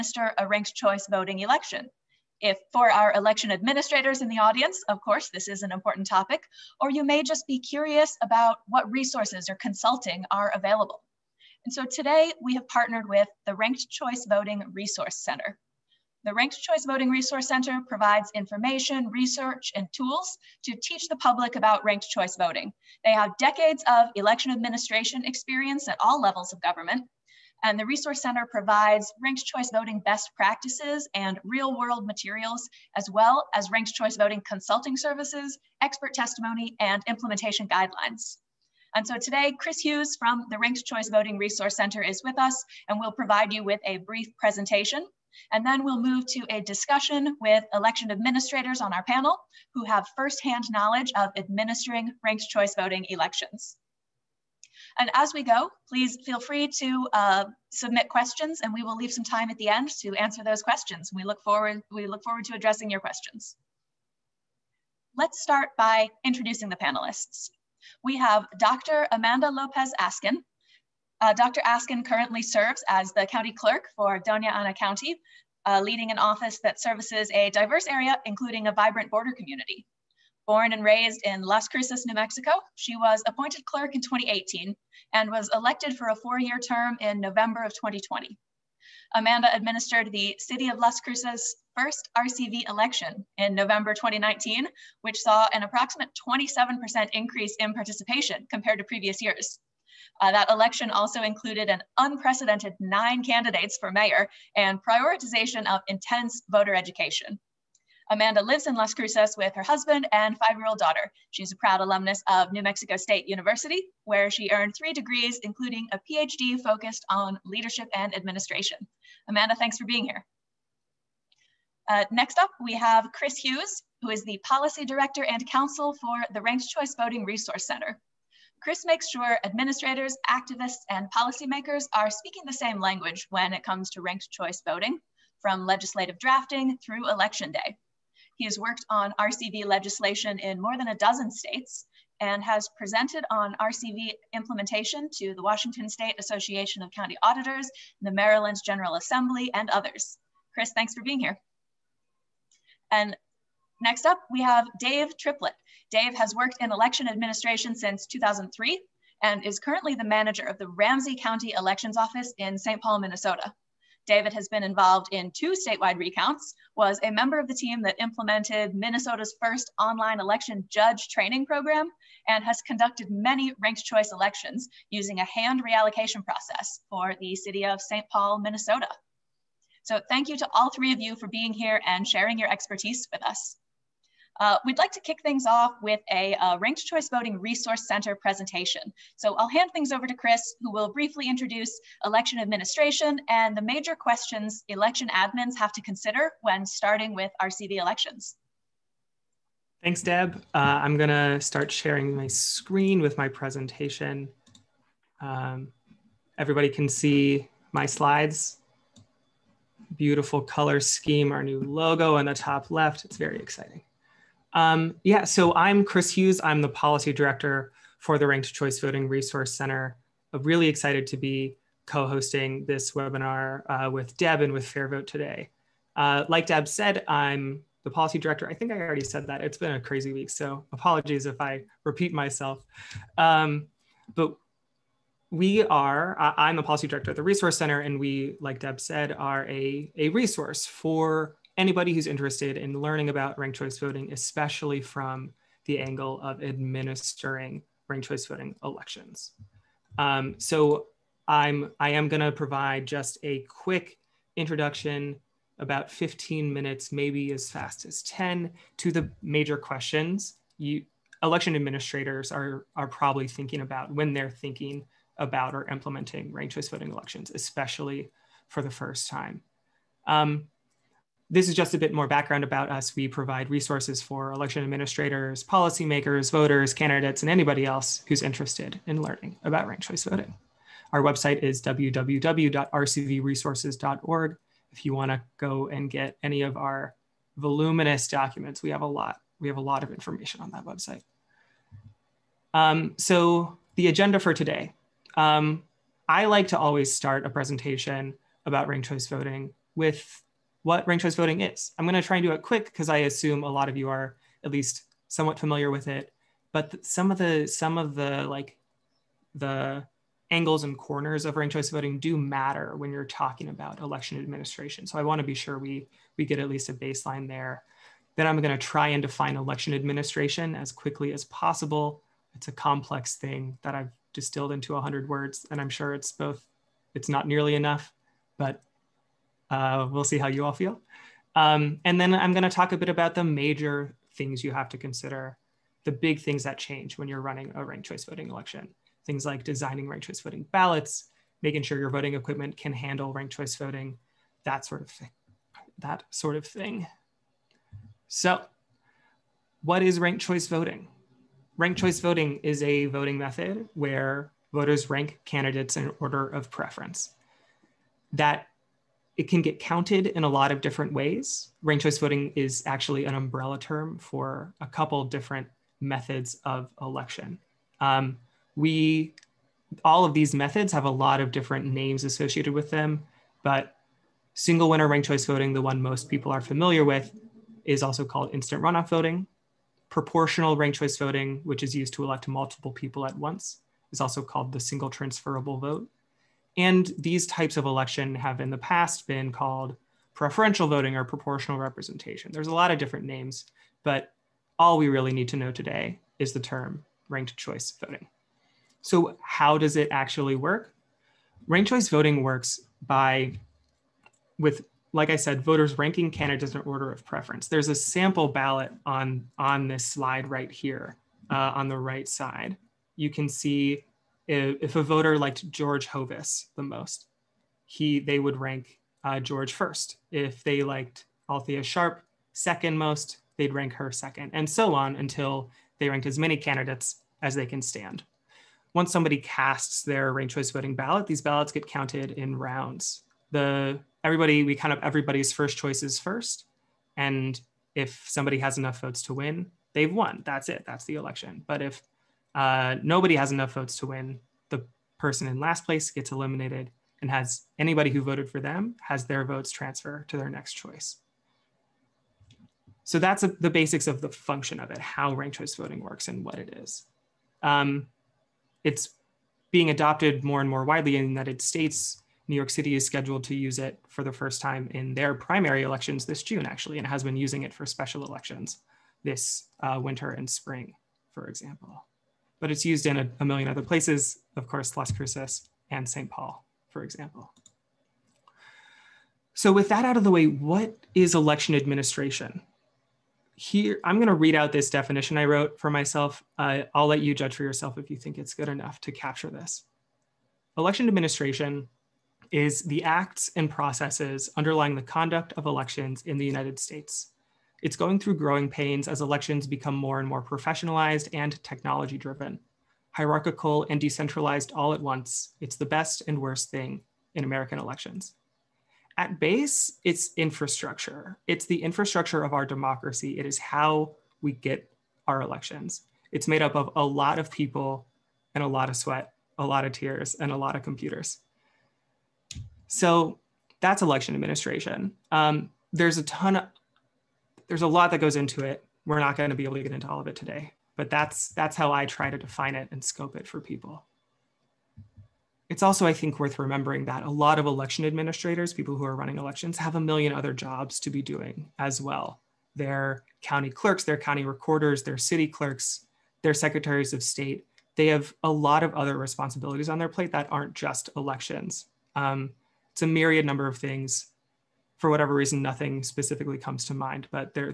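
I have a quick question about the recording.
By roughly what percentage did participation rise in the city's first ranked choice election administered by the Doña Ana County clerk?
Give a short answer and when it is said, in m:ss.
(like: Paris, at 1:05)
27%, at 1:36.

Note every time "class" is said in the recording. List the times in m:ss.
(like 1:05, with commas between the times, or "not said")
not said.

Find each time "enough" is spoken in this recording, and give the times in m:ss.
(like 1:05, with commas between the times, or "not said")
5:27, 7:18, 7:23, 8:08.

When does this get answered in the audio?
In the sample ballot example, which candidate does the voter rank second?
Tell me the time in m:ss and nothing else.
7:01.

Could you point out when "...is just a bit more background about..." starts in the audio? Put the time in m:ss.
4:31.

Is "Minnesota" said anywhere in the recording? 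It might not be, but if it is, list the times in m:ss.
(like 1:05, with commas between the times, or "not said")
2:43, 2:48, 2:58.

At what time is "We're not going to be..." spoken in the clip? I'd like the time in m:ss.
8:48.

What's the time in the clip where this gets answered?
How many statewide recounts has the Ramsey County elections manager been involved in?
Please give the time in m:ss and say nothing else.
2:45.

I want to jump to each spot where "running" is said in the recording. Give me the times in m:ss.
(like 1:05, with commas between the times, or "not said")
5:37, 8:58.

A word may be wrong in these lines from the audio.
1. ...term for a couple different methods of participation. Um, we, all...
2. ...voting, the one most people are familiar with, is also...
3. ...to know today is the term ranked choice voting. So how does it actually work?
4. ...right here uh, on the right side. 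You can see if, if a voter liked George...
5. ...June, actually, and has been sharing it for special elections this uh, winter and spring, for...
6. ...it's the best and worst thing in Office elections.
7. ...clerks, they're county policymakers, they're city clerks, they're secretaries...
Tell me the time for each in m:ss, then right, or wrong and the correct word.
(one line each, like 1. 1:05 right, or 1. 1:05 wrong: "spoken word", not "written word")
1. 6:03 wrong: "election", not "participation"
2. 6:15 right
3. 6:35 right
4. 6:50 right
5. 7:46 wrong: "using", not "sharing"
6. 8:25 wrong: "American", not "Office"
7. 9:03 wrong: "recorders", not "policymakers".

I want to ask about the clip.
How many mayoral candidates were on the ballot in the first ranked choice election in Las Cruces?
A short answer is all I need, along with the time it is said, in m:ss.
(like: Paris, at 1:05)
9, at 1:42.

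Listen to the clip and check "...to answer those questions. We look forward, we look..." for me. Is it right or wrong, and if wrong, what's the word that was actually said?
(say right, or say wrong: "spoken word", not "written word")
right.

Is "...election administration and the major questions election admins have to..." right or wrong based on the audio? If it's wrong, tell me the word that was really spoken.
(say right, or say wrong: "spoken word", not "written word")
right.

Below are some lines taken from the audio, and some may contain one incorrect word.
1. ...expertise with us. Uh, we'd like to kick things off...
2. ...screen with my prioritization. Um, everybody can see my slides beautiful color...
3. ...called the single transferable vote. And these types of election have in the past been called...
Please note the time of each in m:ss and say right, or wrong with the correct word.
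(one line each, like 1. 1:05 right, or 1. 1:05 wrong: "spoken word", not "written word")
1. 3:02 right
2. 3:22 wrong: "presentation", not "prioritization"
3. 6:24 right.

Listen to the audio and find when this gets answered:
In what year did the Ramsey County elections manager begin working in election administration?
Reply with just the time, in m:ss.
2:38.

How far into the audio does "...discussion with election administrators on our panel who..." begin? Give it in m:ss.
0:46.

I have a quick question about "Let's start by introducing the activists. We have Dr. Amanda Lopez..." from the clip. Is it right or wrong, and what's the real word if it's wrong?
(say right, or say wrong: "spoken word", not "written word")
wrong: "panelists", not "activists".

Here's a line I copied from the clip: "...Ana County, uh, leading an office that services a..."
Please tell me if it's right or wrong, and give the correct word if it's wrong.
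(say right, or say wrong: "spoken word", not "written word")
right.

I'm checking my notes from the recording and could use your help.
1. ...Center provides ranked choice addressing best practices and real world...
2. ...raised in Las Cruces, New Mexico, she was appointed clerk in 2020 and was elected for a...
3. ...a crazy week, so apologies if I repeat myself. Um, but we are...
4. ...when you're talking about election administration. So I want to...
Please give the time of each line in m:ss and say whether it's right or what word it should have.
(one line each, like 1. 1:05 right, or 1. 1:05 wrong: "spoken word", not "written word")
1. 0:28 wrong: "voting", not "addressing"
2. 1:20 wrong: "2018", not "2020"
3. 3:49 right
4. 5:12 right.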